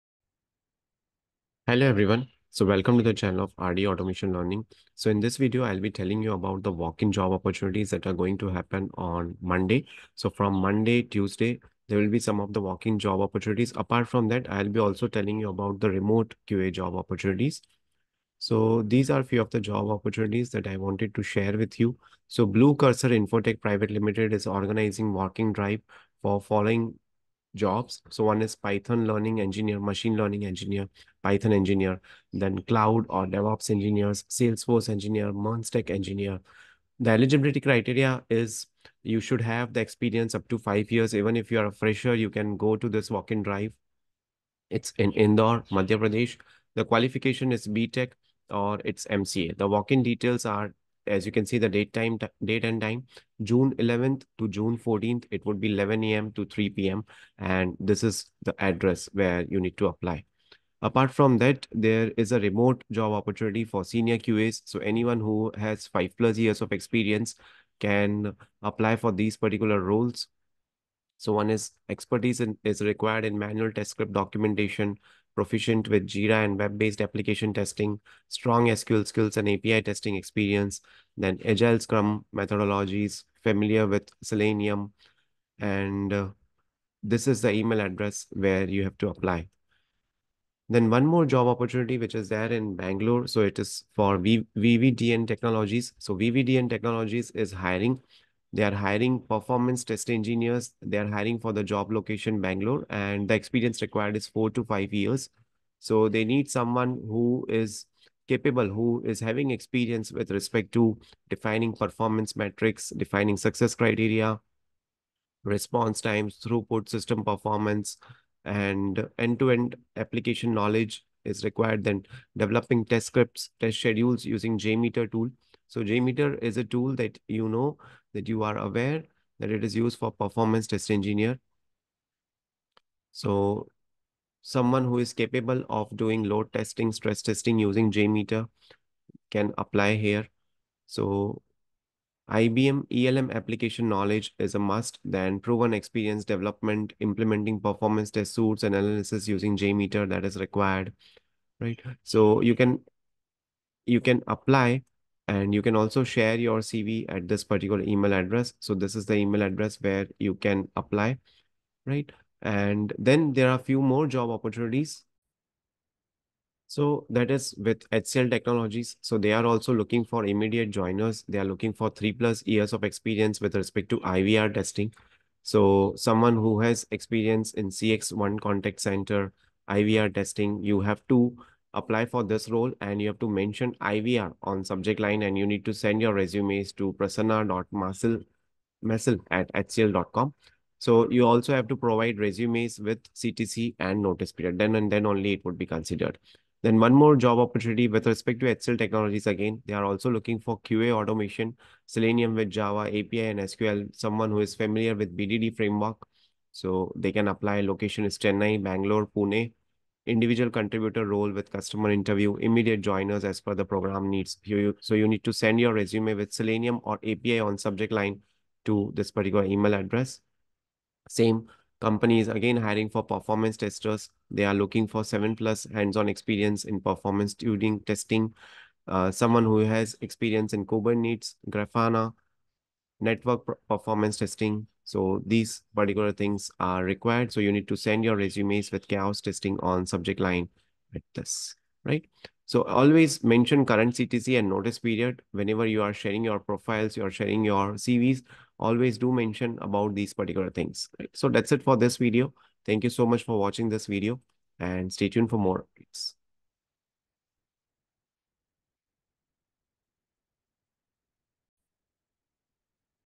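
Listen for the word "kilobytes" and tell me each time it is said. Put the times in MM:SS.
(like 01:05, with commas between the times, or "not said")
not said.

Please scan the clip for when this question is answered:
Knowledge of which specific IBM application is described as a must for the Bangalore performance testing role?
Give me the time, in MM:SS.
02:22.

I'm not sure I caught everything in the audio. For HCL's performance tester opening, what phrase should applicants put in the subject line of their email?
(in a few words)
chaos testing.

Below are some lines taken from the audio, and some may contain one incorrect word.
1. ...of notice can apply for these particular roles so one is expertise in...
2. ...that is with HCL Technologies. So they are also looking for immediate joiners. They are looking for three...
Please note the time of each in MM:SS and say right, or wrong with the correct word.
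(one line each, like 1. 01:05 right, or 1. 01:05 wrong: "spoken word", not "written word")
1. 01:06 wrong: "experience", not "notice"
2. 02:47 right.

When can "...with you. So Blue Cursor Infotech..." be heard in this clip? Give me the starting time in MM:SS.
00:21.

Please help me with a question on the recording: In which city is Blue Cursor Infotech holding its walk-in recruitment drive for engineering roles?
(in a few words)
Indore.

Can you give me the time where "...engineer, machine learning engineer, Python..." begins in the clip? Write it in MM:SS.
00:29.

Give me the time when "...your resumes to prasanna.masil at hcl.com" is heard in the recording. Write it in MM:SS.
03:06.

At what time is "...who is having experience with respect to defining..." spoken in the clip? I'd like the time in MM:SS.
01:48.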